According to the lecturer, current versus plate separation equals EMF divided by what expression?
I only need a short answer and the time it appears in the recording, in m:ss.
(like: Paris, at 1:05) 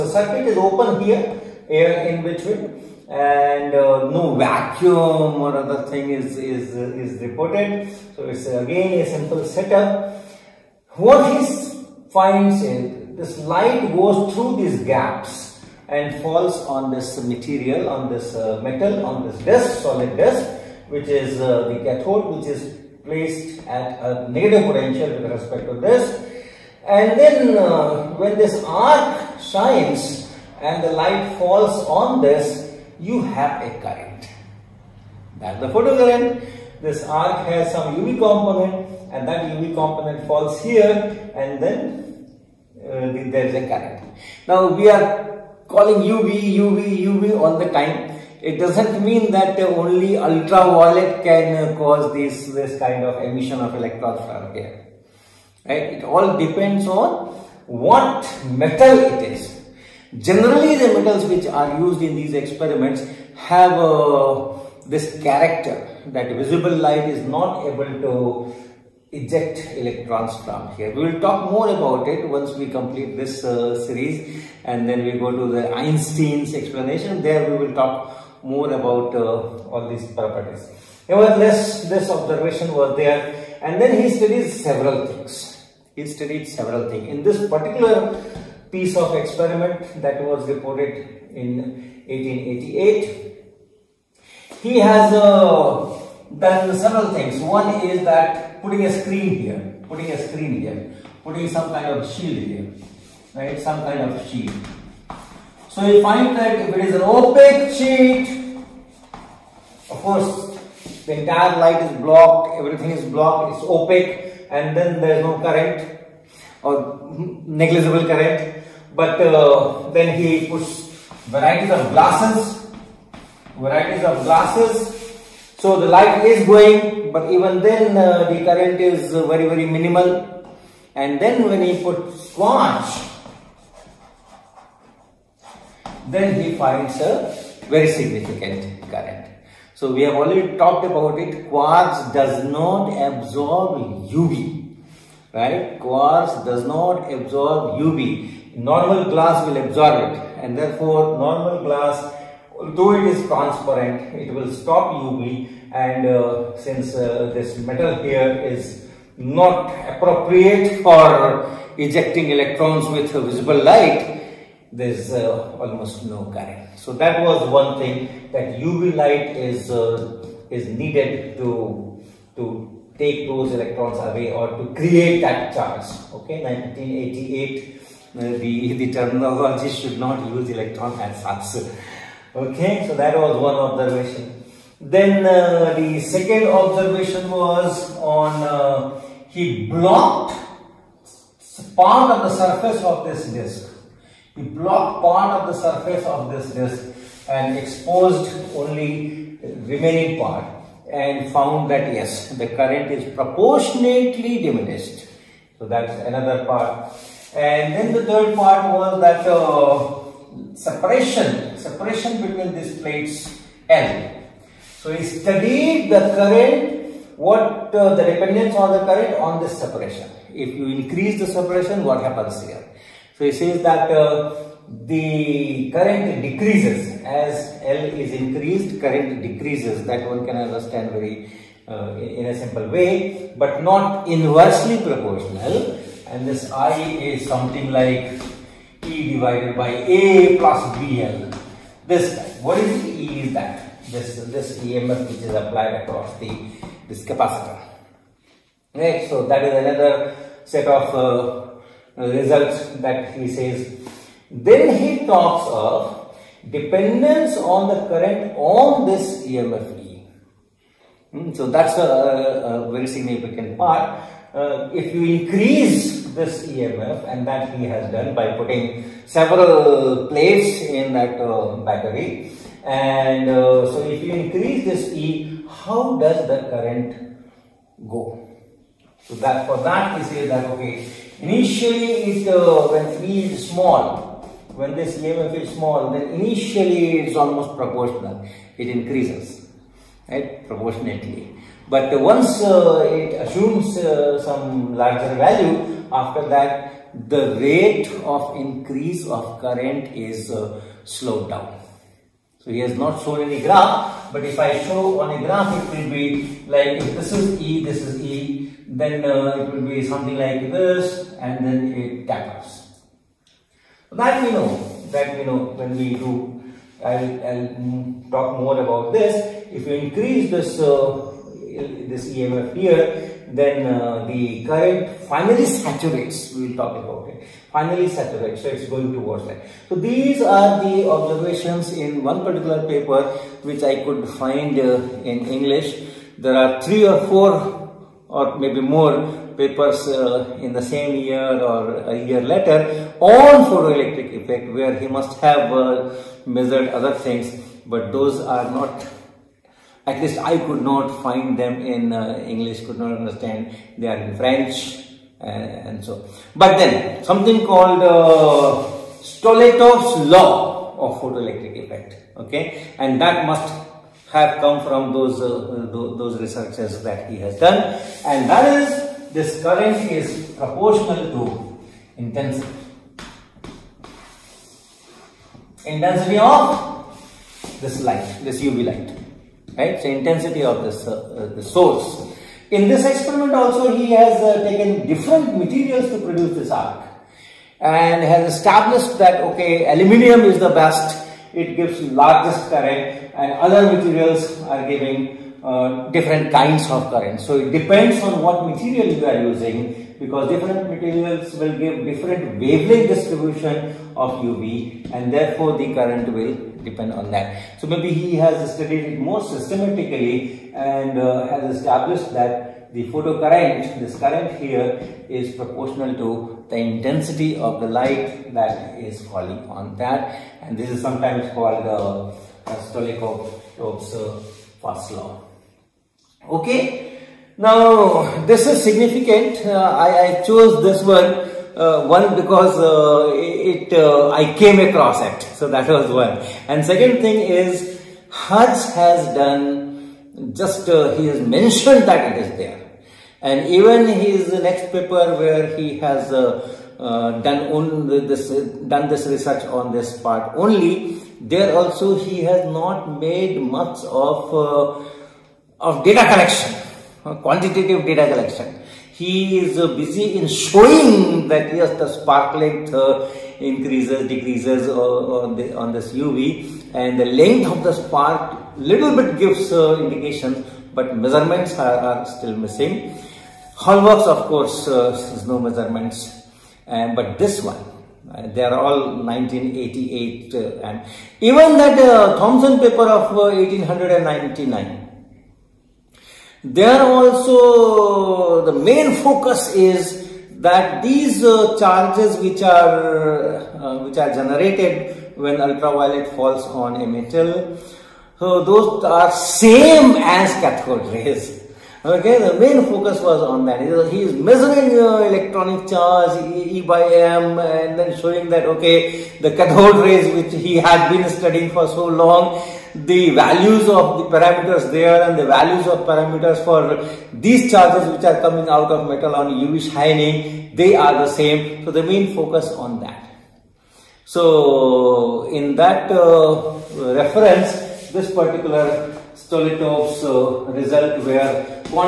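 A plus BL, at 4:00.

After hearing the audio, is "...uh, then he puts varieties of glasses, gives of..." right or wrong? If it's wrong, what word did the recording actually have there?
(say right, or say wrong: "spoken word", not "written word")
wrong: "varieties", not "gives".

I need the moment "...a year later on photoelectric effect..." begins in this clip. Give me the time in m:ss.
5:41.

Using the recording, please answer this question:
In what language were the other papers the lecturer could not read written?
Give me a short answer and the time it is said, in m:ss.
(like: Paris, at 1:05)
French, at 5:54.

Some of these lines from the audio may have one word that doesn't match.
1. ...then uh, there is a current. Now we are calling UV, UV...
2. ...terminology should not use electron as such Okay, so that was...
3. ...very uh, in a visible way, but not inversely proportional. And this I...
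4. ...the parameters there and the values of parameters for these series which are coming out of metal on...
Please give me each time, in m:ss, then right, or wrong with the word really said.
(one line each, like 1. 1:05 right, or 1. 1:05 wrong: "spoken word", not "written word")
1. 0:41 right
2. 2:58 right
3. 3:50 wrong: "simple", not "visible"
4. 8:33 wrong: "charges", not "series".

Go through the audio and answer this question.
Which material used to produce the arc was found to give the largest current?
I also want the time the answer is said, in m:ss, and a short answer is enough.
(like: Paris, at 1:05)
aluminium, at 6:29.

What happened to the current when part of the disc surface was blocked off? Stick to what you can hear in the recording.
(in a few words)
proportionately diminished.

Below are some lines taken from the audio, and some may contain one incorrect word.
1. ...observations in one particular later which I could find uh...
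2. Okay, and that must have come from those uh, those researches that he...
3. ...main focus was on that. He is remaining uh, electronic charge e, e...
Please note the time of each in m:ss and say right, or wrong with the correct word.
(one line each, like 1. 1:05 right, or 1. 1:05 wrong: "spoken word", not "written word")
1. 5:30 wrong: "paper", not "later"
2. 6:02 right
3. 8:22 wrong: "measuring", not "remaining".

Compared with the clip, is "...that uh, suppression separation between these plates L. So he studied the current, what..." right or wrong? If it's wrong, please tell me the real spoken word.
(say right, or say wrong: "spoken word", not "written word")
right.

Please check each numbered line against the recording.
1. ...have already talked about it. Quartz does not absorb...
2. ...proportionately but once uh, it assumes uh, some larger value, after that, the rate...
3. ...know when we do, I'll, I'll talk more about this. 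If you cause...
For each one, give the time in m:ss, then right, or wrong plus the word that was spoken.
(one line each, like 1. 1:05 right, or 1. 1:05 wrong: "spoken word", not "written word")
1. 2:20 right
2. 4:50 right
3. 5:15 wrong: "increase", not "cause".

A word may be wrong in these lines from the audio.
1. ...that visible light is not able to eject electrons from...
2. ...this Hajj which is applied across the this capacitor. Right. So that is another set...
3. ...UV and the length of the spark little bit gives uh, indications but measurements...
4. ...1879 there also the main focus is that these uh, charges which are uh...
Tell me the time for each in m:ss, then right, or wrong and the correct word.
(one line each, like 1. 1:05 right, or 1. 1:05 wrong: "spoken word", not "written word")
1. 1:06 right
2. 4:04 wrong: "EMF", not "Hajj"
3. 7:45 right
4. 8:03 wrong: "1899", not "1879".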